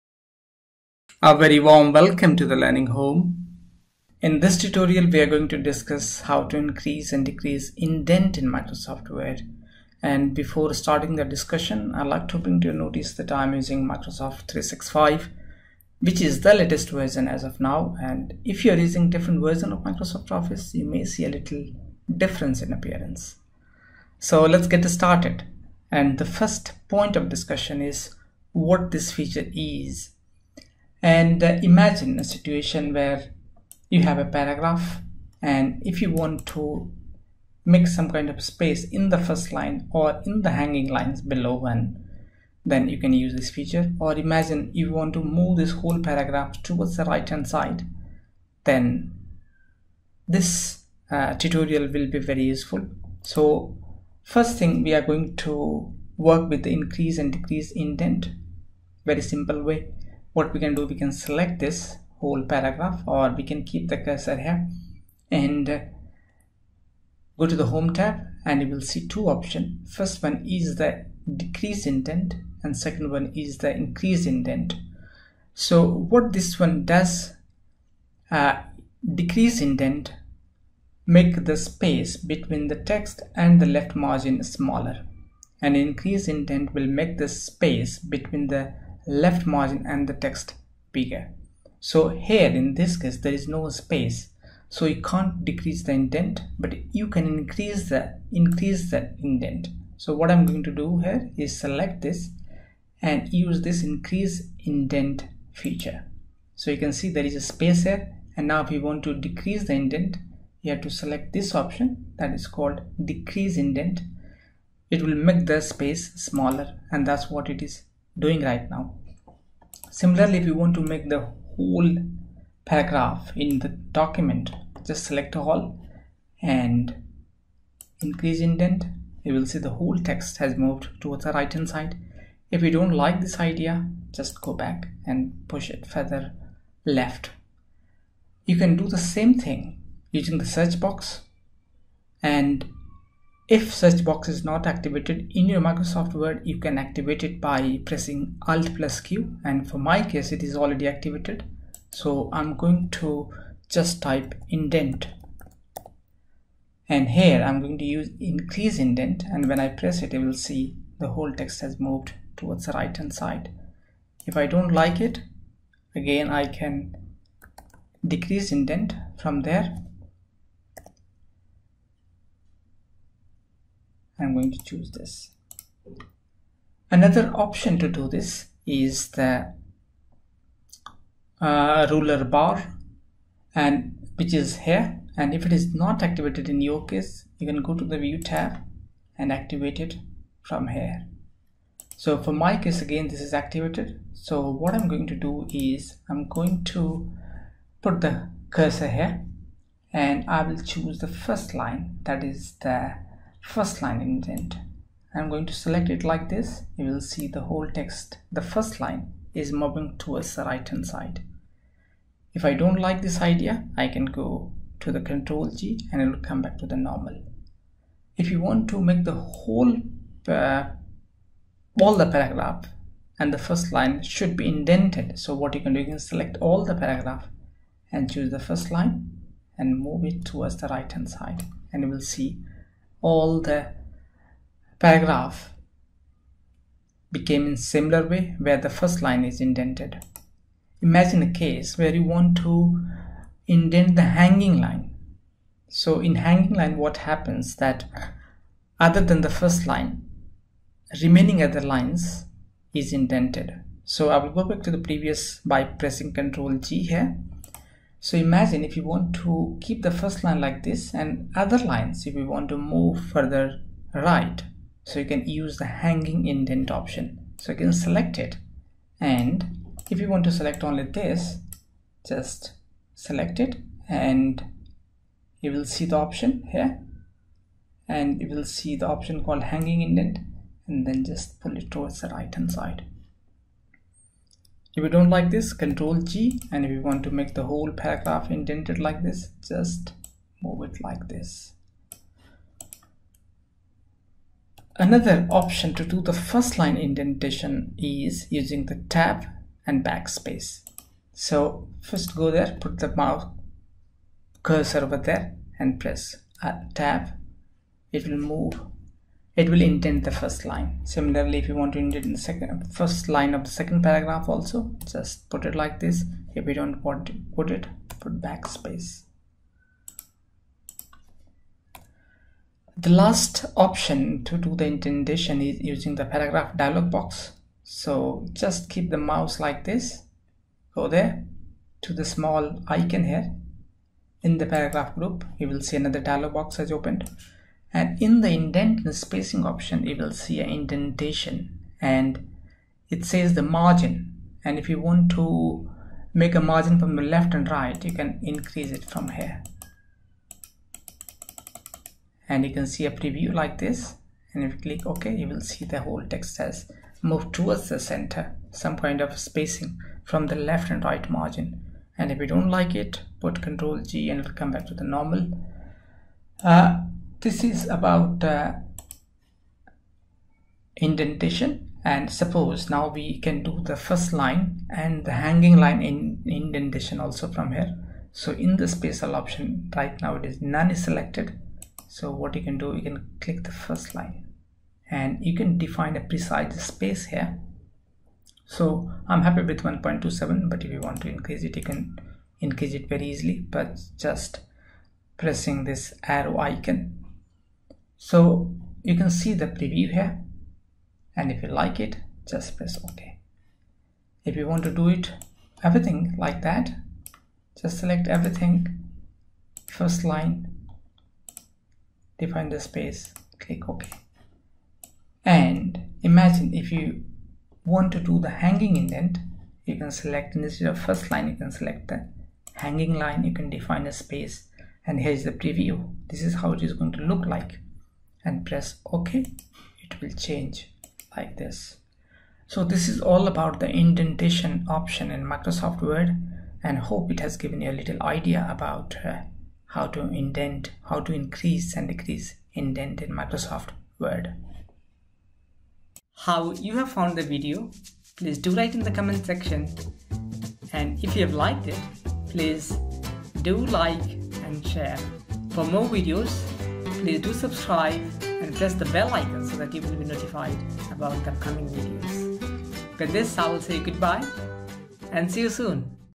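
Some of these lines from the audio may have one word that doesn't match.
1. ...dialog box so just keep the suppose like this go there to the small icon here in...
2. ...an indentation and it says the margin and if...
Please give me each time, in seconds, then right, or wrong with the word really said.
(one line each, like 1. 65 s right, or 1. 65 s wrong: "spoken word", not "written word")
1. 326 s wrong: "mouse", not "suppose"
2. 340 s right.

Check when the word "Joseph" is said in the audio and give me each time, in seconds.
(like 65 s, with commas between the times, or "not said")
not said.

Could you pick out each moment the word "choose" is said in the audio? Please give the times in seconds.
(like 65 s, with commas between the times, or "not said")
174 s, 200 s, 228 s.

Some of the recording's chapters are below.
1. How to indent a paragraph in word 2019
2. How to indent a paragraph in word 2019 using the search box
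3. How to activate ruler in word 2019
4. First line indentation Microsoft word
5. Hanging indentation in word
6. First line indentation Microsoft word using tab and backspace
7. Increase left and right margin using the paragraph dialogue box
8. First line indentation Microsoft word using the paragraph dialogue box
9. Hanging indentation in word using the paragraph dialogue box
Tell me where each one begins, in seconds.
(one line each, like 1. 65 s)
1. 60 s
2. 135 s
3. 180 s
4. 200 s
5. 240 s
6. 295 s
7. 325 s
8. 372 s
9. 415 s.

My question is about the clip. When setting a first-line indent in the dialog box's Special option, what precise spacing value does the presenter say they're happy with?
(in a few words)
1.27.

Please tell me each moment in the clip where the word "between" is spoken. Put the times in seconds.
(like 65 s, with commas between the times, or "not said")
82 s, 87 s.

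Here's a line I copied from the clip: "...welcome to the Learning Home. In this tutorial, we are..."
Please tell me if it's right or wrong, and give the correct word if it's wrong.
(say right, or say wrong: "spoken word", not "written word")
right.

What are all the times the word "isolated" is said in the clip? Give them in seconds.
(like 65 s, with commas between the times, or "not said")
not said.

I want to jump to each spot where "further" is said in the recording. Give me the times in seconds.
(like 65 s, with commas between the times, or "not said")
135 s, 262 s.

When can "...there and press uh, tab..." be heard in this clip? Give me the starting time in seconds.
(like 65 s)
304 s.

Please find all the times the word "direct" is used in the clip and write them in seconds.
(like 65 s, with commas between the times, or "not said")
not said.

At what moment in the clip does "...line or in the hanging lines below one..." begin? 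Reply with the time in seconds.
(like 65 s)
39 s.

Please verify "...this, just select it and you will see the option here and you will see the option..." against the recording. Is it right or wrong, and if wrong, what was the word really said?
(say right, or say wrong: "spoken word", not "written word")
right.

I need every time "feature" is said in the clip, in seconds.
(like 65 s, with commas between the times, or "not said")
29 s, 43 s, 105 s.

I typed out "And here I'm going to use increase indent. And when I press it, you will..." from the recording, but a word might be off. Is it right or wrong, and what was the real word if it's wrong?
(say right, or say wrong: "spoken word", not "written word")
right.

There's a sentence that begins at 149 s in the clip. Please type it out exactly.
And for my case, it is already activated.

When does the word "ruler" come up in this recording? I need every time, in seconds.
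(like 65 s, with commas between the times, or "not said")
181 s.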